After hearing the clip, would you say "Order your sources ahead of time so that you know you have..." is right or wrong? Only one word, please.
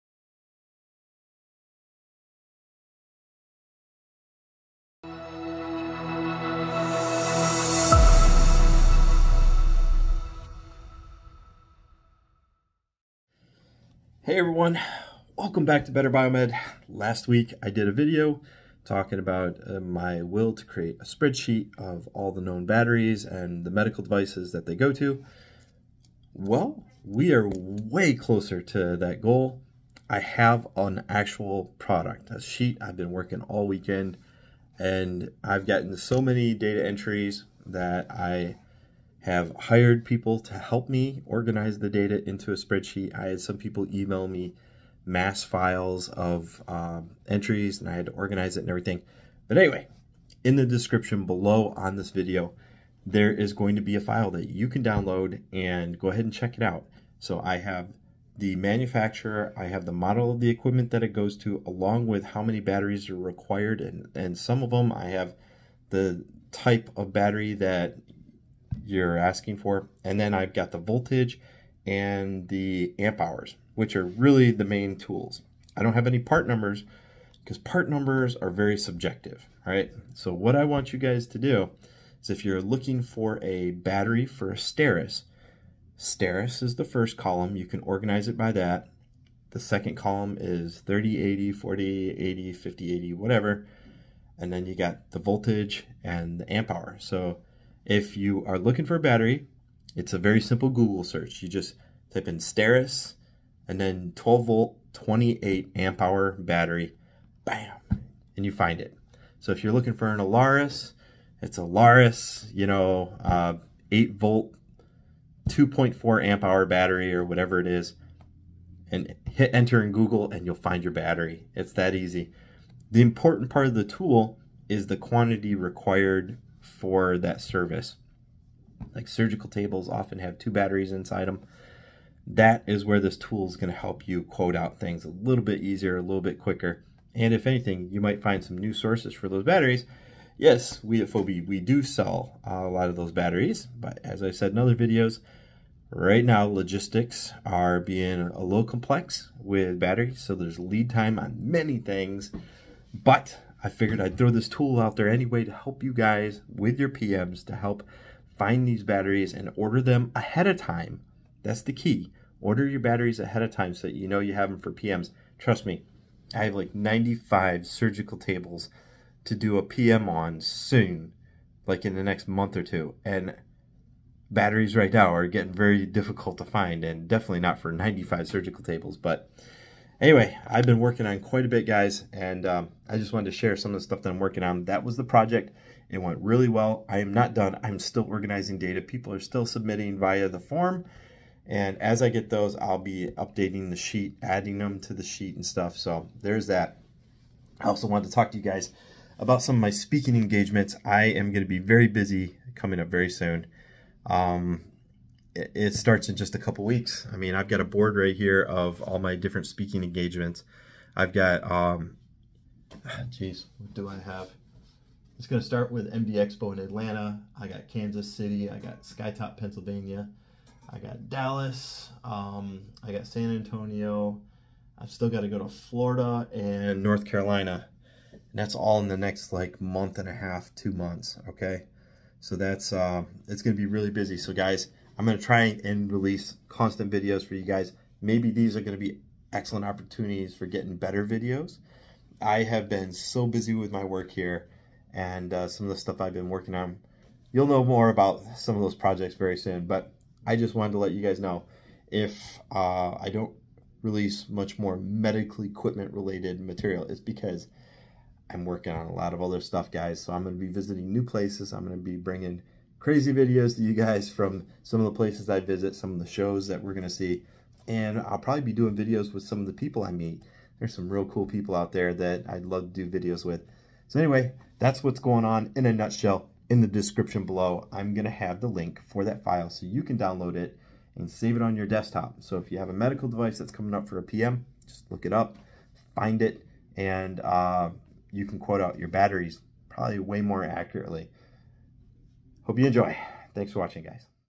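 wrong.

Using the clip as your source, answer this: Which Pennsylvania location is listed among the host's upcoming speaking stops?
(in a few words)
Skytop.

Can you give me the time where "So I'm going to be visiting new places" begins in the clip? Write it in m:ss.
4:20.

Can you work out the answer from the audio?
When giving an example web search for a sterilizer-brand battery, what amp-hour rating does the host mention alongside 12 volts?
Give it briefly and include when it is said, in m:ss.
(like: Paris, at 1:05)
28 amp hour, at 1:44.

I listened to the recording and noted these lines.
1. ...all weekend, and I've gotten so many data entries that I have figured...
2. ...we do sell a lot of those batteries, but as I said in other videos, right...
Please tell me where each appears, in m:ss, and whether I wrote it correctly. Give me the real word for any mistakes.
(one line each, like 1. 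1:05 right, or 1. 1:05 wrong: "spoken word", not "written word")
1. 0:33 wrong: "hired", not "figured"
2. 2:21 right.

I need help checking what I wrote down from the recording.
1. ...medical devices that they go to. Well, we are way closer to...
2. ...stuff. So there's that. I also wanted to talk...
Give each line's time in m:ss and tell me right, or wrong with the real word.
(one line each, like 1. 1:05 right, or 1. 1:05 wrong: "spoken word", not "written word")
1. 0:23 right
2. 3:15 right.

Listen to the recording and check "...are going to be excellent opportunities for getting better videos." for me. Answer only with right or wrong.
right.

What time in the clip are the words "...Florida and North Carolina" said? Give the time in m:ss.
3:45.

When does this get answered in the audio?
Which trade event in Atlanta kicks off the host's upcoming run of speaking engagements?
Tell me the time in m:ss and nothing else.
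3:35.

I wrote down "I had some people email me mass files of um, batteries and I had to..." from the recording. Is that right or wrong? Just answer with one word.
wrong.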